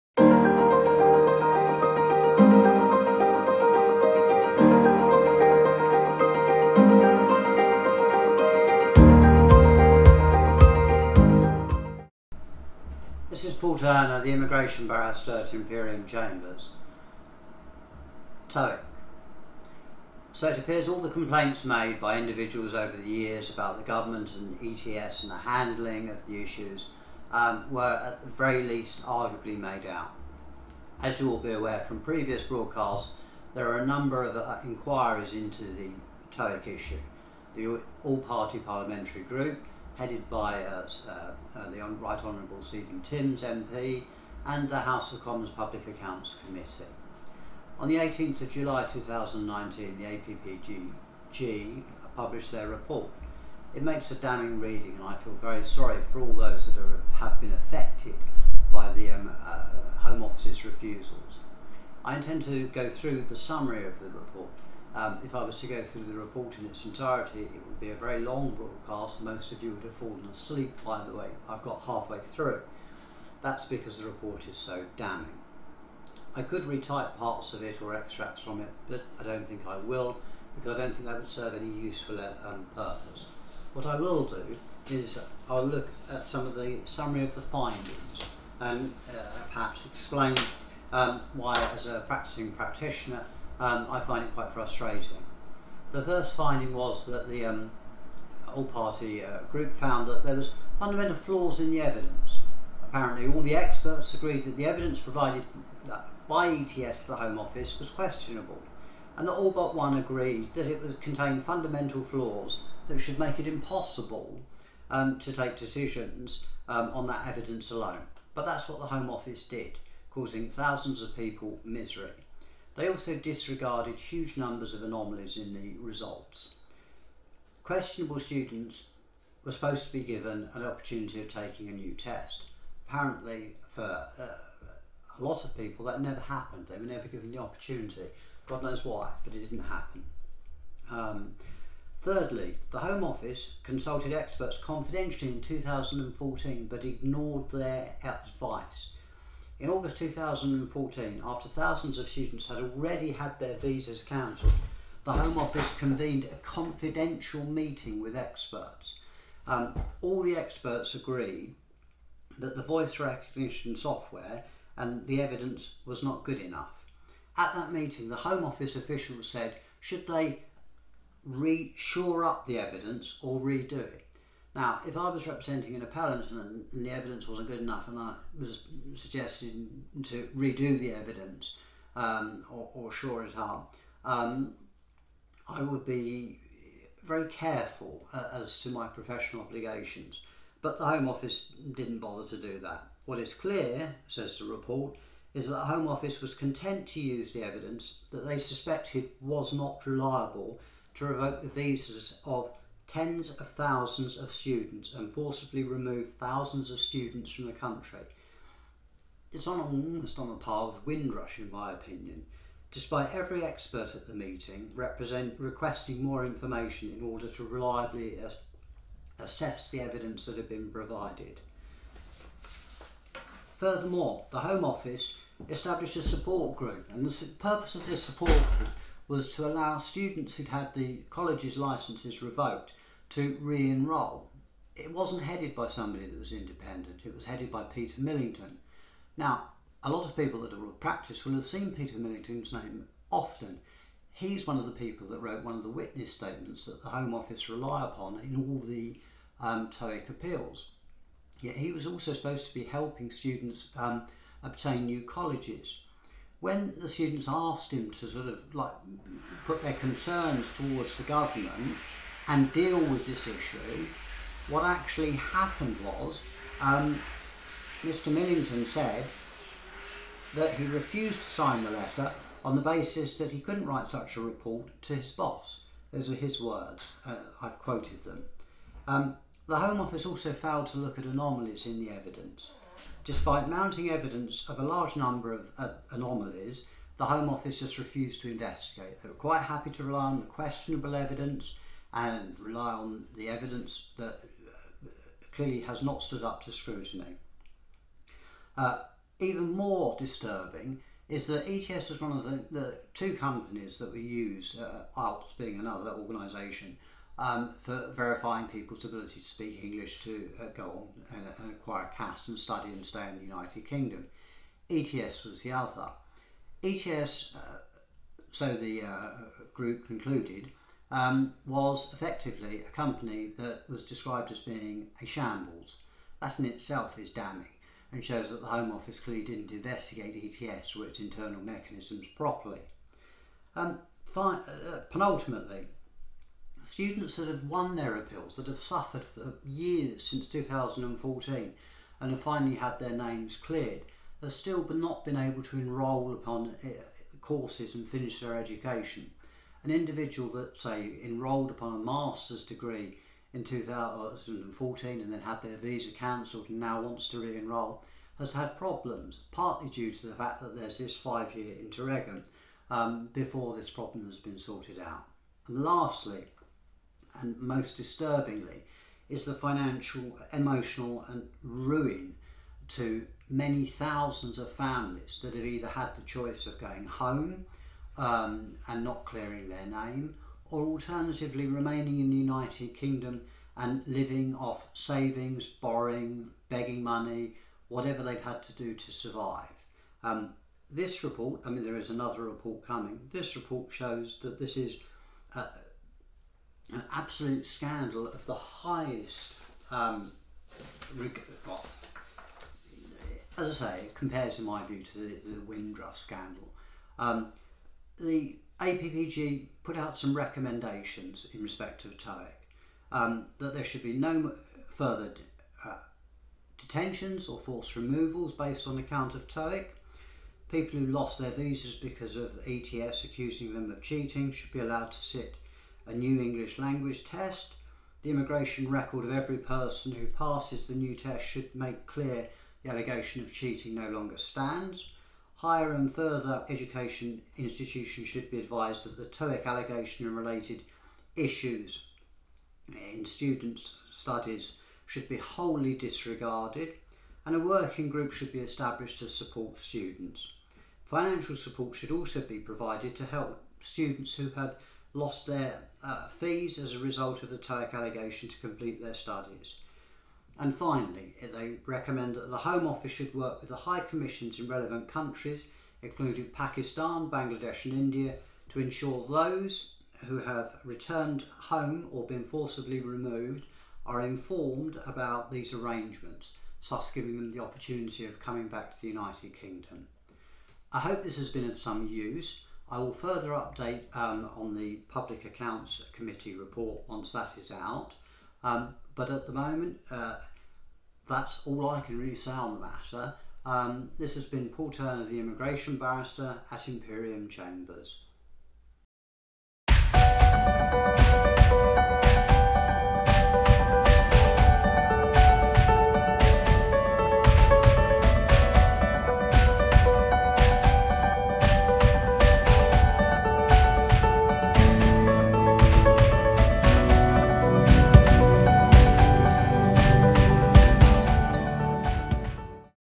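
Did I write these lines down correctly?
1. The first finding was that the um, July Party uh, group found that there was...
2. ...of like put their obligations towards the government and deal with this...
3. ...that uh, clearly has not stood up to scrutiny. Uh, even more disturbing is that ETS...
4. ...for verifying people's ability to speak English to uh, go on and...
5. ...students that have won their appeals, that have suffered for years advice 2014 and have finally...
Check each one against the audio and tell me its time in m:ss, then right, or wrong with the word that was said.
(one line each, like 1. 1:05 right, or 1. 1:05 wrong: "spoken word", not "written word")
1. 1:35 wrong: "All", not "July"
2. 4:18 wrong: "concerns", not "obligations"
3. 4:53 right
4. 5:07 right
5. 5:36 wrong: "since", not "advice".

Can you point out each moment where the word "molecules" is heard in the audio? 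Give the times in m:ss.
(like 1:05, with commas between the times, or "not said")
not said.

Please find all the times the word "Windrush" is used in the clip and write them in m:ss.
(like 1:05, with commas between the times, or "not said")
3:30, 6:45.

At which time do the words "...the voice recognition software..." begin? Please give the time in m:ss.
2:42.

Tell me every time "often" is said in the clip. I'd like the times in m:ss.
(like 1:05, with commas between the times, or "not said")
4:03.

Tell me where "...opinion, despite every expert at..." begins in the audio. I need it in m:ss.
3:31.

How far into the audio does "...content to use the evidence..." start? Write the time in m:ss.
3:16.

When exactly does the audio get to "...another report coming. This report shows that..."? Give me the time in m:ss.
6:31.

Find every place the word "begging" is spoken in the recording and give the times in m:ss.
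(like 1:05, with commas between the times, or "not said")
6:26.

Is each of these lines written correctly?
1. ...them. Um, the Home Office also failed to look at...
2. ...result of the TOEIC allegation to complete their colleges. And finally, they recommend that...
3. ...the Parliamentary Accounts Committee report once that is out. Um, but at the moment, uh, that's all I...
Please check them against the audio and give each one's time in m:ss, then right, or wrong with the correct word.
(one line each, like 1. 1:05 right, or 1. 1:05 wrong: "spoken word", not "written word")
1. 4:38 right
2. 7:36 wrong: "studies", not "colleges"
3. 8:04 wrong: "Public", not "Parliamentary".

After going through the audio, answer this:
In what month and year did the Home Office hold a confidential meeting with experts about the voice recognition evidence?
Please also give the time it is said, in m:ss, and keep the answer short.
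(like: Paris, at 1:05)
August 2014, at 2:29.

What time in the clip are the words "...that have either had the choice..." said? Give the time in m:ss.
6:15.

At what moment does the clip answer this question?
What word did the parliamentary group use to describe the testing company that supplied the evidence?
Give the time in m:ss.
5:25.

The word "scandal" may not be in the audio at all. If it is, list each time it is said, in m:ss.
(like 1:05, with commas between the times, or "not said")
6:37, 6:45.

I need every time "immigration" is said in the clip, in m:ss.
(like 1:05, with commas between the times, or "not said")
0:14, 7:08, 8:15.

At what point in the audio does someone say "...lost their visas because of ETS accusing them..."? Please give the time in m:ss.
7:00.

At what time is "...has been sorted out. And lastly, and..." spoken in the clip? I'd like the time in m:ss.
6:04.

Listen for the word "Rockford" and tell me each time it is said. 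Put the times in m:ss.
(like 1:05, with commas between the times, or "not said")
not said.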